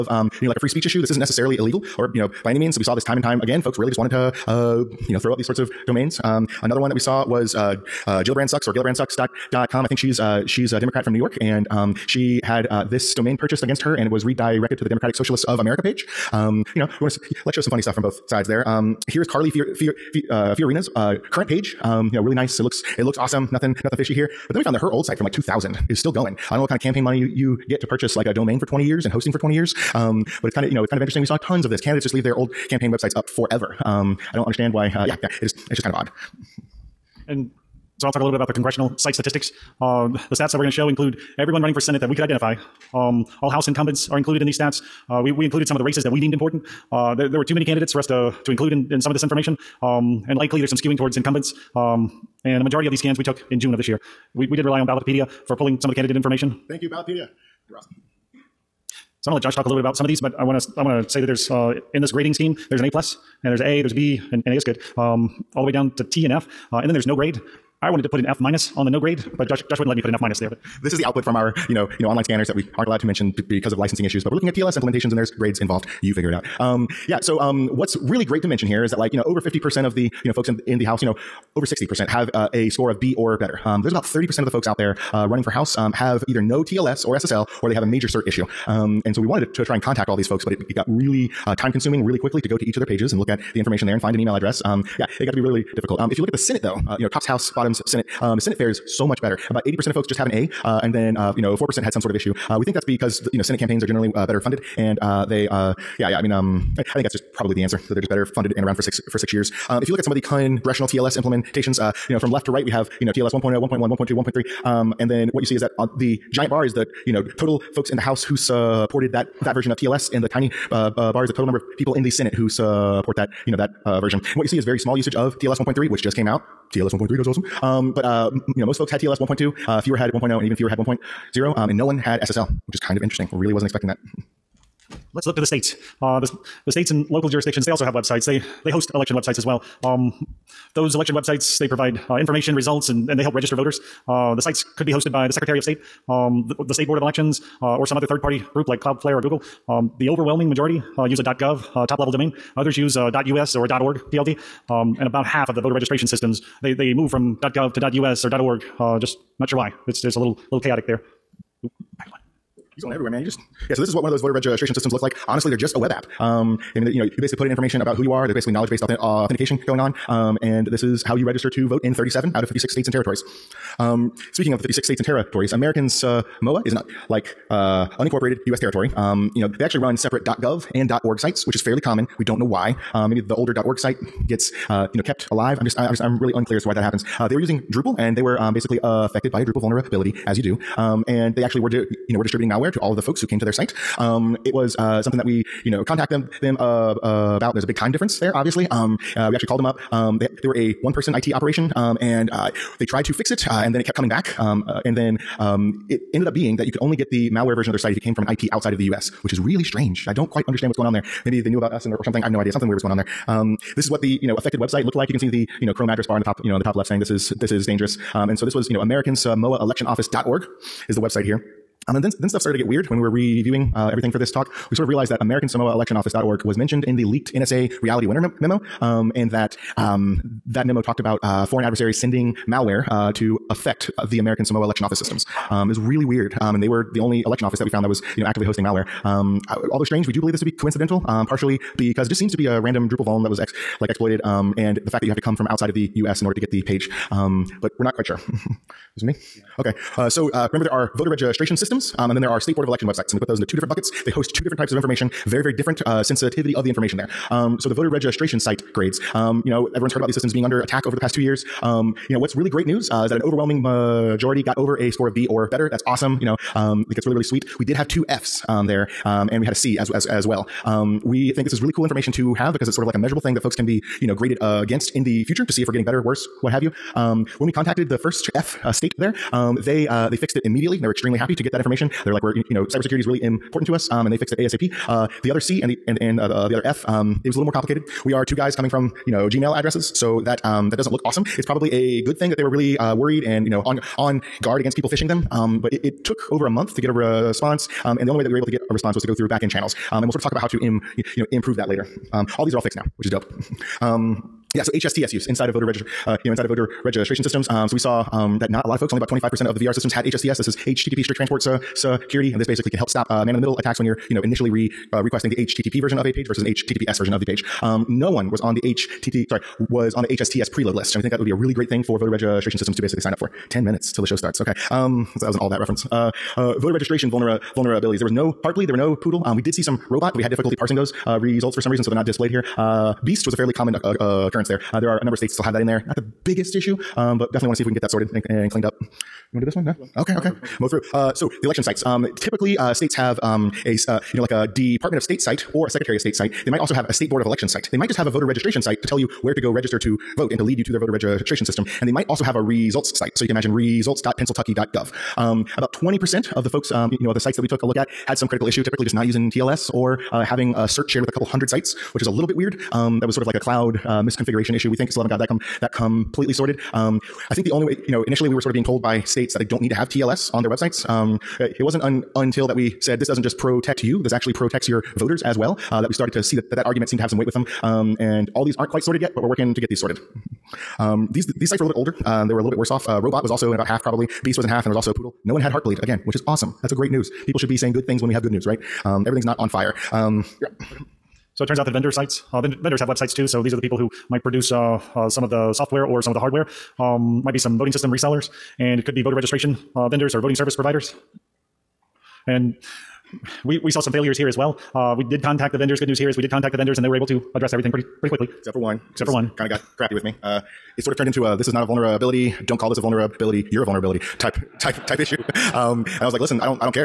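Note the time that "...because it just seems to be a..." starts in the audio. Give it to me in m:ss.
4:01.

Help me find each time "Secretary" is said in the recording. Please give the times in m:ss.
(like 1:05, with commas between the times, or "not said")
2:25, 5:45.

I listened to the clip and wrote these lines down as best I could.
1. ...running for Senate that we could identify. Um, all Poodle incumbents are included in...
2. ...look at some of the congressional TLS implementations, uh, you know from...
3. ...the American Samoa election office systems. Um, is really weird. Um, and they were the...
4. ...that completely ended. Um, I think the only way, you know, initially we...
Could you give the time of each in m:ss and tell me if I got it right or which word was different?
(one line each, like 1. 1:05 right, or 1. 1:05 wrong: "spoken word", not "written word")
1. 0:41 wrong: "House", not "Poodle"
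2. 1:49 right
3. 3:54 right
4. 6:05 wrong: "sorted", not "ended".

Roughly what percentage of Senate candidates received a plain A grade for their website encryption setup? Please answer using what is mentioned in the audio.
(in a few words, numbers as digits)
80%.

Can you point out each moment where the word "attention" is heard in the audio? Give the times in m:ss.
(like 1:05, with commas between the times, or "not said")
not said.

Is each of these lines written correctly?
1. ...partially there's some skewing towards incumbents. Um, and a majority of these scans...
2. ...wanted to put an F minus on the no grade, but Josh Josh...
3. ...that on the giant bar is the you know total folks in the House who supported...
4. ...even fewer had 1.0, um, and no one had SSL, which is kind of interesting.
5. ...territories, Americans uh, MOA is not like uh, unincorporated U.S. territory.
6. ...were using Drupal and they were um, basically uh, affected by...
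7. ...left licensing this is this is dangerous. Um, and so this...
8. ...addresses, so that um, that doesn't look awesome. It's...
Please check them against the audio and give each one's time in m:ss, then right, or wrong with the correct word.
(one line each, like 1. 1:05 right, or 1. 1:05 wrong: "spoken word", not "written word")
1. 0:50 wrong: "likely", not "partially"
2. 1:07 right
3. 1:55 right
4. 2:10 right
5. 2:55 right
6. 3:07 right
7. 3:36 wrong: "saying", not "licensing"
8. 4:49 right.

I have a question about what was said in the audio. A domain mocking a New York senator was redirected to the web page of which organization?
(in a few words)
Democratic Socialists of America.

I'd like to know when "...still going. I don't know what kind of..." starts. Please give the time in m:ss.
0:25.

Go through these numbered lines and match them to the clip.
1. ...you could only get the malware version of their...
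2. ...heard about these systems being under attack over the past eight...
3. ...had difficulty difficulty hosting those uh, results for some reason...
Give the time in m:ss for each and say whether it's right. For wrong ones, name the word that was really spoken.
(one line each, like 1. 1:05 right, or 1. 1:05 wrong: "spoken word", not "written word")
1. 3:26 right
2. 4:19 wrong: "two", not "eight"
3. 5:30 wrong: "parsing", not "hosting".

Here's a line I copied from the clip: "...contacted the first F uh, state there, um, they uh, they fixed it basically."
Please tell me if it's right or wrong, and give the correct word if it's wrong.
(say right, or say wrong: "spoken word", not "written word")
wrong: "immediately", not "basically".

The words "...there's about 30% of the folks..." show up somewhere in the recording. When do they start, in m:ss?
1:23.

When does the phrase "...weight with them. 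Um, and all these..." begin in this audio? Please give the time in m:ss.
6:17.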